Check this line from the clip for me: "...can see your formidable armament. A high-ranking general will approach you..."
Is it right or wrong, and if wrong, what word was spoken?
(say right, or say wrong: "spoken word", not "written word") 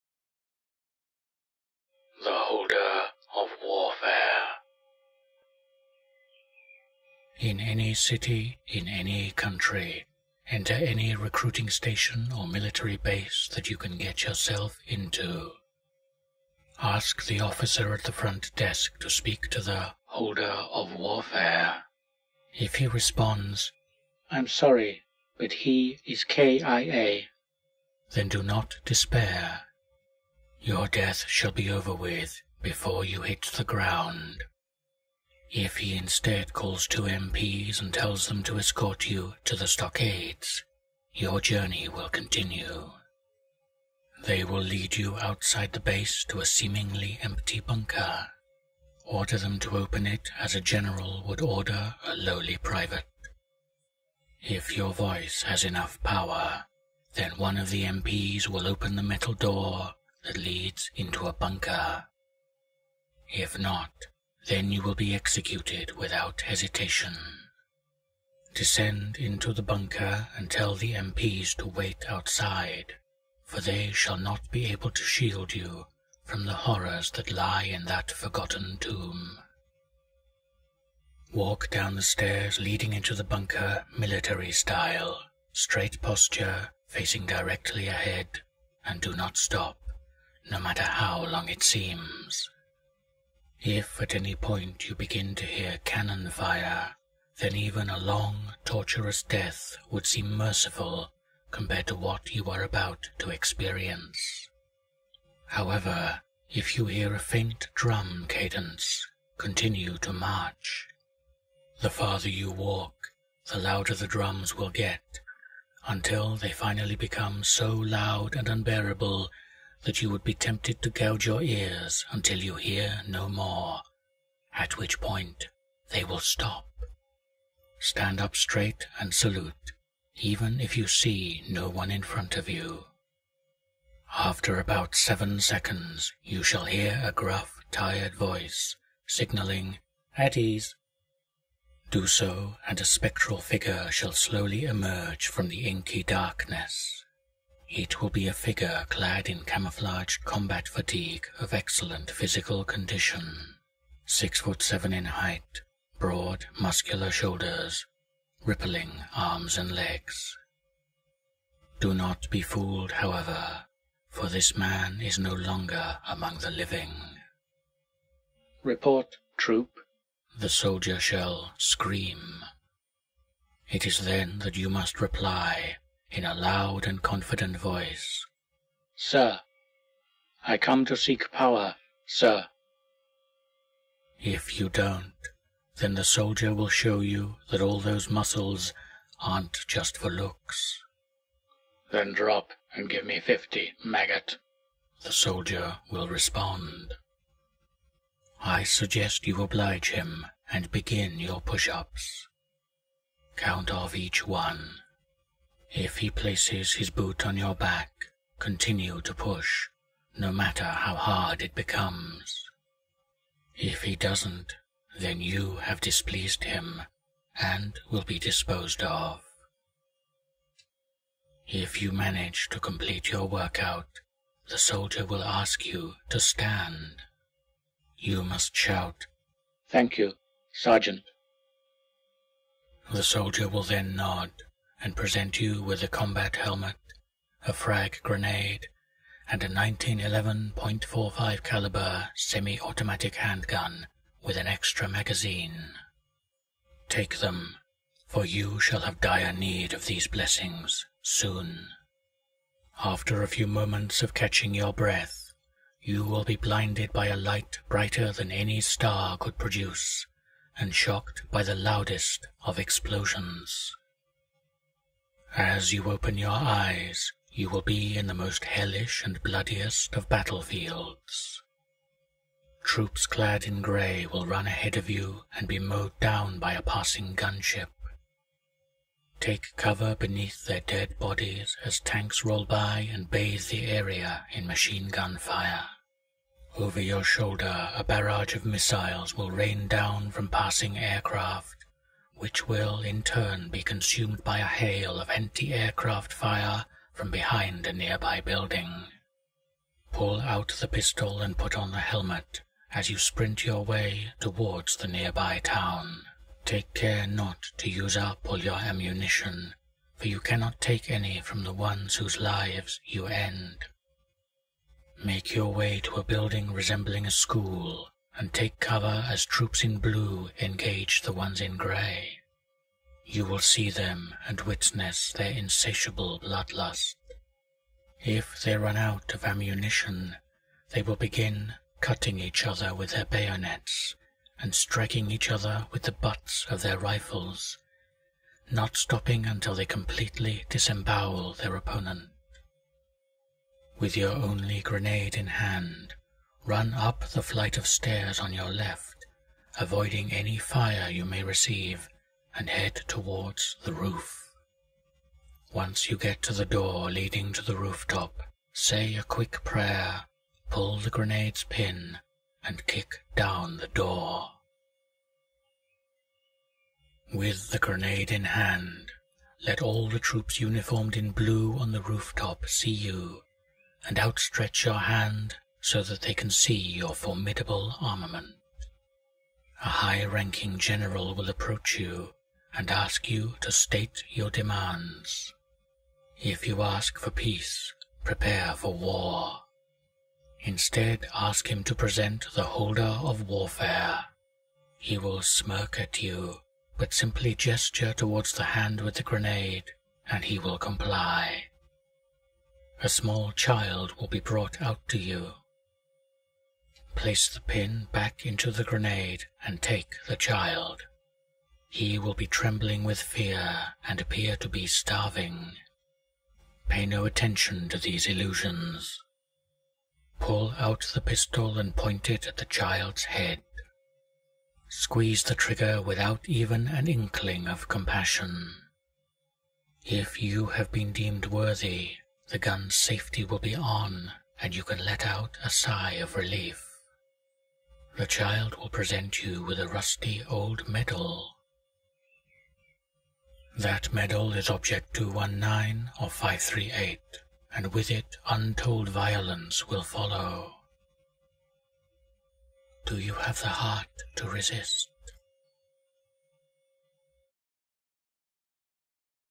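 right.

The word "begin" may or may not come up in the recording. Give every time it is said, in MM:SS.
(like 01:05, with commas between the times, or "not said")
01:34, 03:20, 05:30.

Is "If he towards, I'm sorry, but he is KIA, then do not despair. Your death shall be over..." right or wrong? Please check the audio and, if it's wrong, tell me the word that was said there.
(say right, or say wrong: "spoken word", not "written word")
wrong: "responds", not "towards".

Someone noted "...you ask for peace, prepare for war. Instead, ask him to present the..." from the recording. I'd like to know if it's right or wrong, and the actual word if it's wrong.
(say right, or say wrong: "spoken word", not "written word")
right.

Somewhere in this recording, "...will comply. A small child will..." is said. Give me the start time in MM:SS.
06:40.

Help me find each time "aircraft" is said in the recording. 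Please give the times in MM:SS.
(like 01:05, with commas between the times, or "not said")
04:50, 04:55.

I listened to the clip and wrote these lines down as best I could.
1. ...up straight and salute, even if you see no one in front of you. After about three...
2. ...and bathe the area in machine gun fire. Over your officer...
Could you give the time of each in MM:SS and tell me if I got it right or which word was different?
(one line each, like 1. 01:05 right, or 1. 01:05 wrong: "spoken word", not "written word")
1. 02:08 wrong: "seven", not "three"
2. 04:42 wrong: "shoulder", not "officer".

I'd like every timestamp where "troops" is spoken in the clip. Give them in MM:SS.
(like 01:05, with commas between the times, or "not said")
02:49, 04:32, 05:19, 06:09.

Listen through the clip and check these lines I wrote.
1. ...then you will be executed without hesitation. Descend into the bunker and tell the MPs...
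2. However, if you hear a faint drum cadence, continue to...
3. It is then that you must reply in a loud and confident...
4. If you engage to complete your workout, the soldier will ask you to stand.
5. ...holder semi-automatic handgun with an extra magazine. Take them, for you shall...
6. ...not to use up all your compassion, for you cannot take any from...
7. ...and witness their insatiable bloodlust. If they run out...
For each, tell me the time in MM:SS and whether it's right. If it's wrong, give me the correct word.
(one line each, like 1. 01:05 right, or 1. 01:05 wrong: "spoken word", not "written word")
1. 01:04 right
2. 01:45 right
3. 02:53 right
4. 03:41 wrong: "manage", not "engage"
5. 04:01 wrong: "caliber", not "holder"
6. 05:07 wrong: "ammunition", not "compassion"
7. 05:24 right.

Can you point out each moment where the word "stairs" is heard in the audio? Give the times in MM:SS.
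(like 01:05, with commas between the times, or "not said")
01:22, 05:47.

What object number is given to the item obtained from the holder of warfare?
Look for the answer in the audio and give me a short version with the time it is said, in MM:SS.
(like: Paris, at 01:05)
219, at 07:24.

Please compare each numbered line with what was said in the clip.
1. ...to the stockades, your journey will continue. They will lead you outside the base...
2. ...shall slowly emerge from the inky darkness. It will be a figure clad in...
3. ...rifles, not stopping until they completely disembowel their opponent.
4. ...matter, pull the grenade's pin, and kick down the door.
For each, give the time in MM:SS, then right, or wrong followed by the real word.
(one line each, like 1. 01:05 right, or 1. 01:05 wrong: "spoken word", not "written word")
1. 00:39 right
2. 02:23 right
3. 05:36 right
4. 05:59 wrong: "prayer", not "matter".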